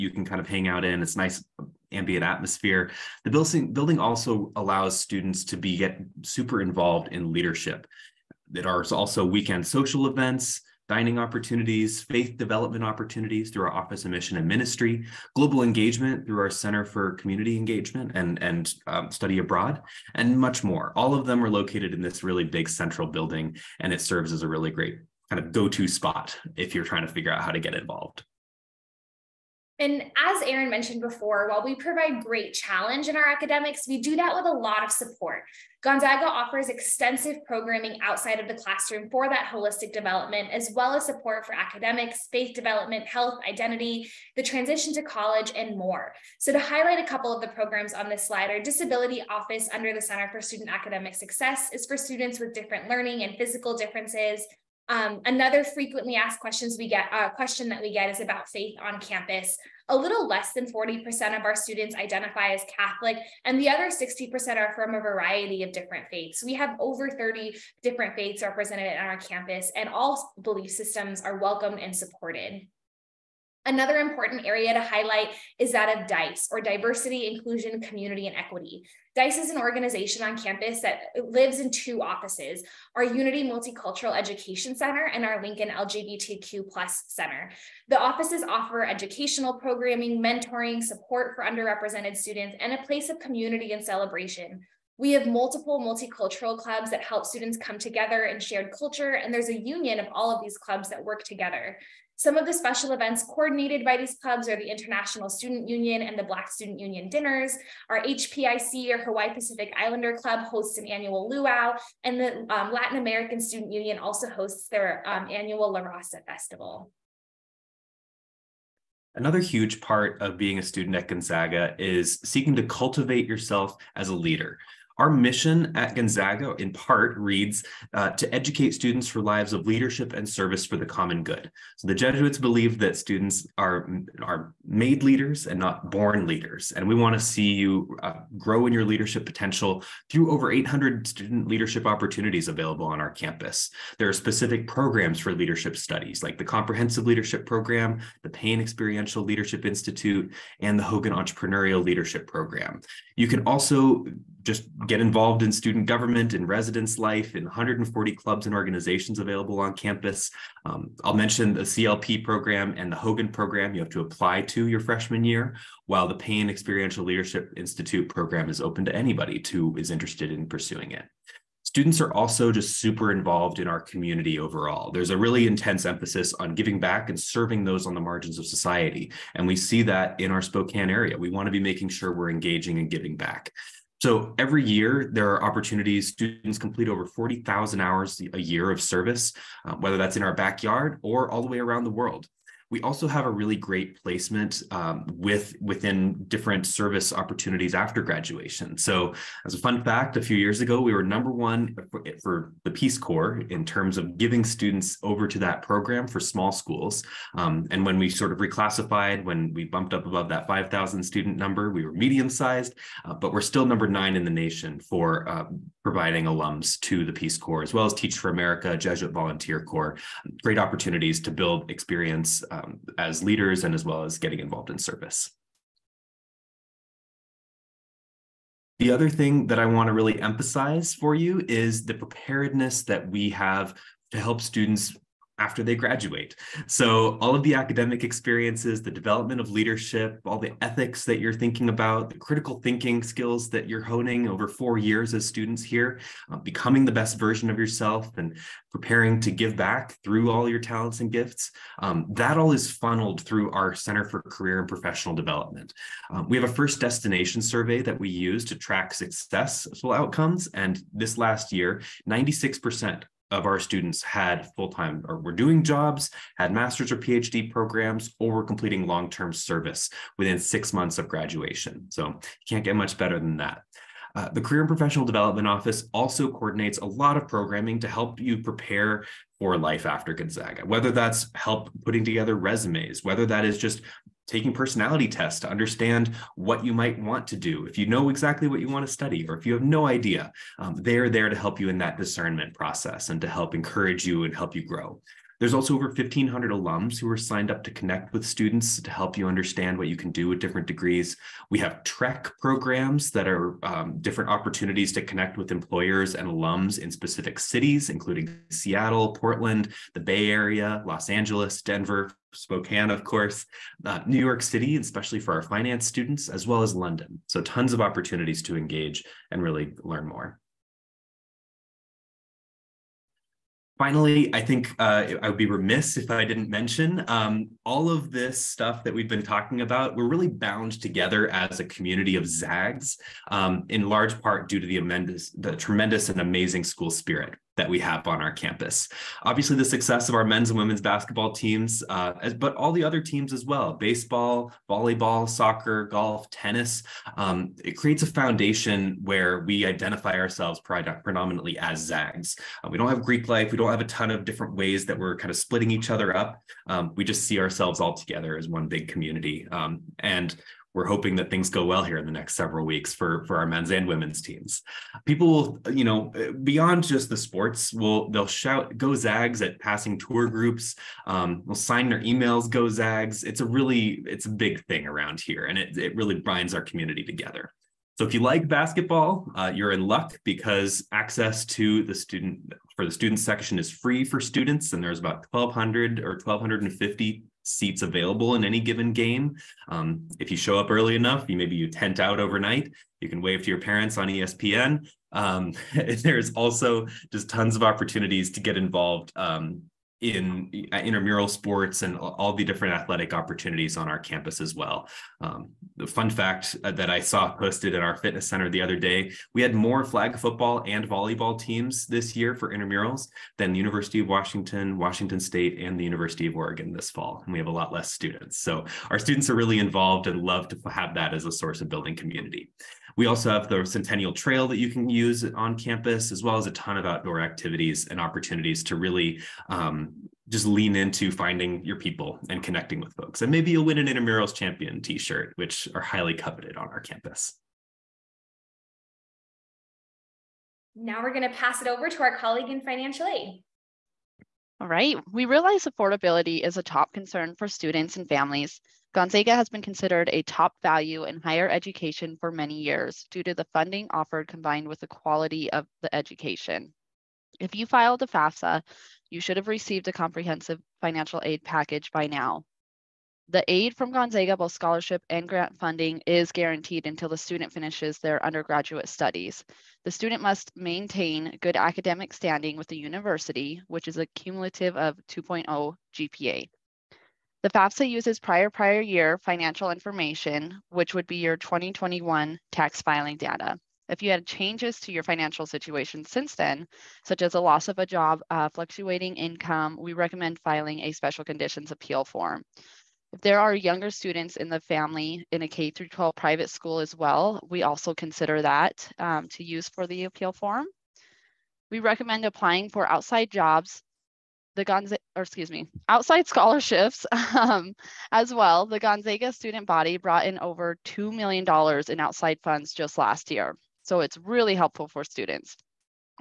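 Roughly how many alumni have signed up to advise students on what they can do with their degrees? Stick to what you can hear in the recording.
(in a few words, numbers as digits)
over 1,500.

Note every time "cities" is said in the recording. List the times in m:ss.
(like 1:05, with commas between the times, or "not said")
5:07.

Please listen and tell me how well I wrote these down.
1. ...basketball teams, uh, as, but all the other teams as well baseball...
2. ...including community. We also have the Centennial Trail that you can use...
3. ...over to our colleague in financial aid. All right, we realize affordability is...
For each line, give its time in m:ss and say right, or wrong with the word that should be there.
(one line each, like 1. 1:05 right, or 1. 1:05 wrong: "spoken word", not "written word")
1. 5:40 right
2. 7:01 wrong: "building", not "including"
3. 7:21 right.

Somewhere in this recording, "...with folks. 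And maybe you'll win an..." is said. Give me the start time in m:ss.
7:12.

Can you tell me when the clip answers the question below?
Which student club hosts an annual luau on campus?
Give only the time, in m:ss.
1:49.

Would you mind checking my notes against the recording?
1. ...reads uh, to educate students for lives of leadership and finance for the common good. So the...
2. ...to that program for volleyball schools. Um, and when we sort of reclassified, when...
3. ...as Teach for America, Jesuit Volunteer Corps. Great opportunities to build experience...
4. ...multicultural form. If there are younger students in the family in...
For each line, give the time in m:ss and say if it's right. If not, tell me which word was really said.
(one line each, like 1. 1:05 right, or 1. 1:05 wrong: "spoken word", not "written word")
1. 2:07 wrong: "service", not "finance"
2. 3:25 wrong: "small", not "volleyball"
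3. 3:37 right
4. 8:11 wrong: "appeal", not "multicultural".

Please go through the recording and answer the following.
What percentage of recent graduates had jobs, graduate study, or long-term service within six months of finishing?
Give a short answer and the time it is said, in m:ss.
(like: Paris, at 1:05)
96%, at 4:22.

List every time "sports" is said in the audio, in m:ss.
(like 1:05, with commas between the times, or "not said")
6:07, 6:41.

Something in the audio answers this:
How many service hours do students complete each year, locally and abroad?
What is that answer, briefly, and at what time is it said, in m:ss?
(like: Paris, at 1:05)
over 40,000, at 3:06.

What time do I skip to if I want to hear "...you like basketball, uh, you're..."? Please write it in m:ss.
6:18.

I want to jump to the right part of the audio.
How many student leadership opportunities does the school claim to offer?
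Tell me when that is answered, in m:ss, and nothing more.
2:20.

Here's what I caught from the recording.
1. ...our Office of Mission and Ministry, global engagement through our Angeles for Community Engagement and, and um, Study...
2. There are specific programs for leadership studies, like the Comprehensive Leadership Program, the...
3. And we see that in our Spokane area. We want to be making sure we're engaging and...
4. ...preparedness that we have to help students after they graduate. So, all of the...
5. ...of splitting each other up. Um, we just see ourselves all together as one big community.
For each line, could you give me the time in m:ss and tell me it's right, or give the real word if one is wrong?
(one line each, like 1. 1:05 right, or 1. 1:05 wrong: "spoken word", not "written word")
1. 0:13 wrong: "Center", not "Angeles"
2. 2:23 right
3. 2:59 right
4. 3:51 right
5. 5:55 right.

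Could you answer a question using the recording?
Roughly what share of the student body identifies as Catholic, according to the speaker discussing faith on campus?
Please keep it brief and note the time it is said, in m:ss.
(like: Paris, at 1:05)
less than 40%, at 1:00.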